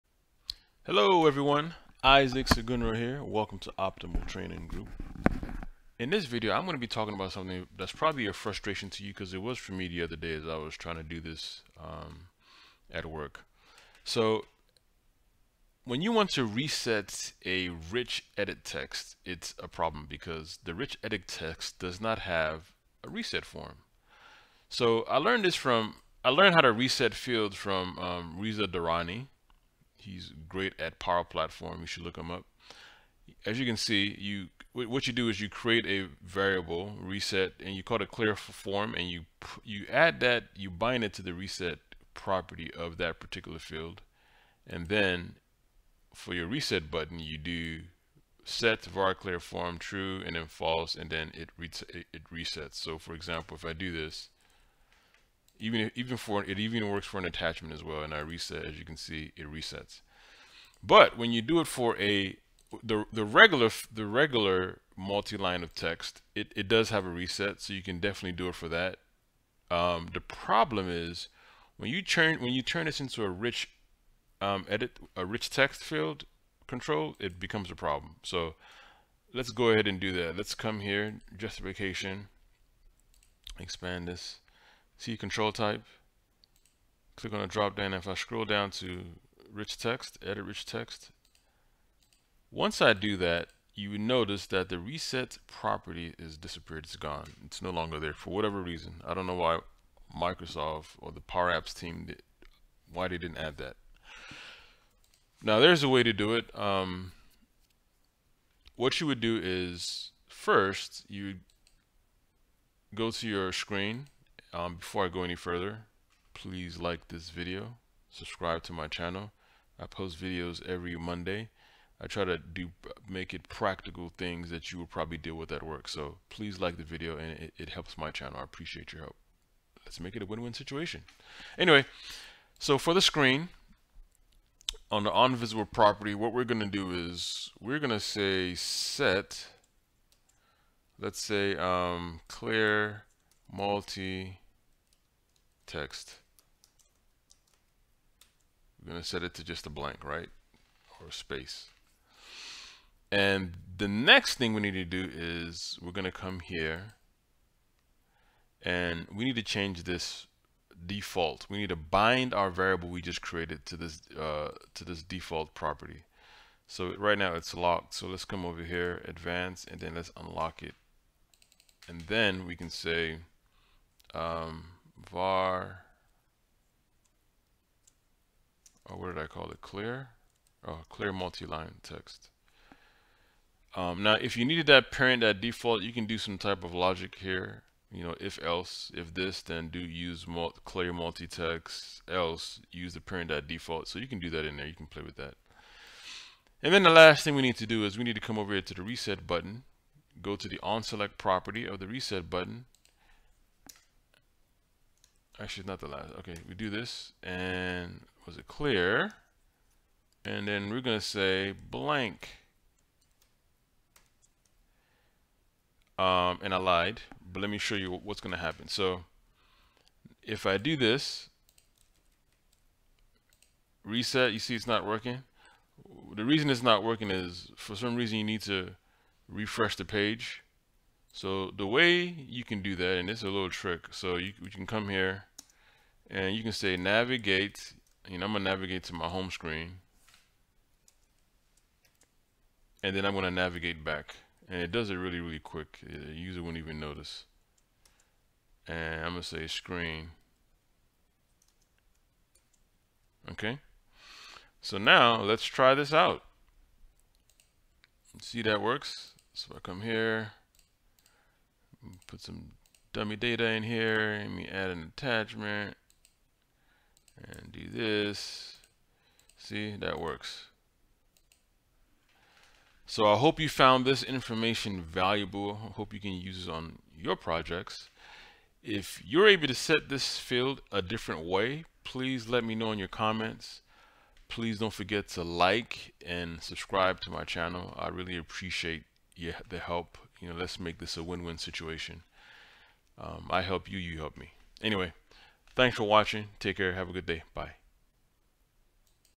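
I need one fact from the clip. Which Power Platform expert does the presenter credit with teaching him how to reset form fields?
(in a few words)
Reza Dorrani.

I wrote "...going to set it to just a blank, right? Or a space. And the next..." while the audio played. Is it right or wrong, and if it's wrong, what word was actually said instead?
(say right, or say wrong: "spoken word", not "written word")
right.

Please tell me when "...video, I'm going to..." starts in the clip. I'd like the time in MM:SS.
00:06.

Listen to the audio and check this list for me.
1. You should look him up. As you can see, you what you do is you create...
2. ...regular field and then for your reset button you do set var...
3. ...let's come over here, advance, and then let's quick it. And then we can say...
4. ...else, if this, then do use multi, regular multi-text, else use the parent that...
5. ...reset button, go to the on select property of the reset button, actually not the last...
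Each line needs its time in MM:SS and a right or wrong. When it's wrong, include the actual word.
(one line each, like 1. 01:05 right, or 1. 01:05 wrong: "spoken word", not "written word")
1. 00:31 right
2. 00:43 wrong: "particular", not "regular"
3. 02:48 wrong: "unlock", not "quick"
4. 03:08 wrong: "clear", not "regular"
5. 03:18 right.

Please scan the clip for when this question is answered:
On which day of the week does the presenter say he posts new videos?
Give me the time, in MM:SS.
02:00.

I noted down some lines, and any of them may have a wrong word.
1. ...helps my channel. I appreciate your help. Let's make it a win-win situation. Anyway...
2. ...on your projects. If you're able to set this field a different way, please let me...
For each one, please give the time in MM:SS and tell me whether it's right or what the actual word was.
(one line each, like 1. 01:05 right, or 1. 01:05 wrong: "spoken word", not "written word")
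1. 02:07 right
2. 04:36 right.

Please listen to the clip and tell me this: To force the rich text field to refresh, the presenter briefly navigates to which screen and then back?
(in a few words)
home screen.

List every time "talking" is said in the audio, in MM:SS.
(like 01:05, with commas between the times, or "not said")
00:06.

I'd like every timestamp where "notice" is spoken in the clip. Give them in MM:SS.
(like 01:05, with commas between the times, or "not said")
01:34, 04:06.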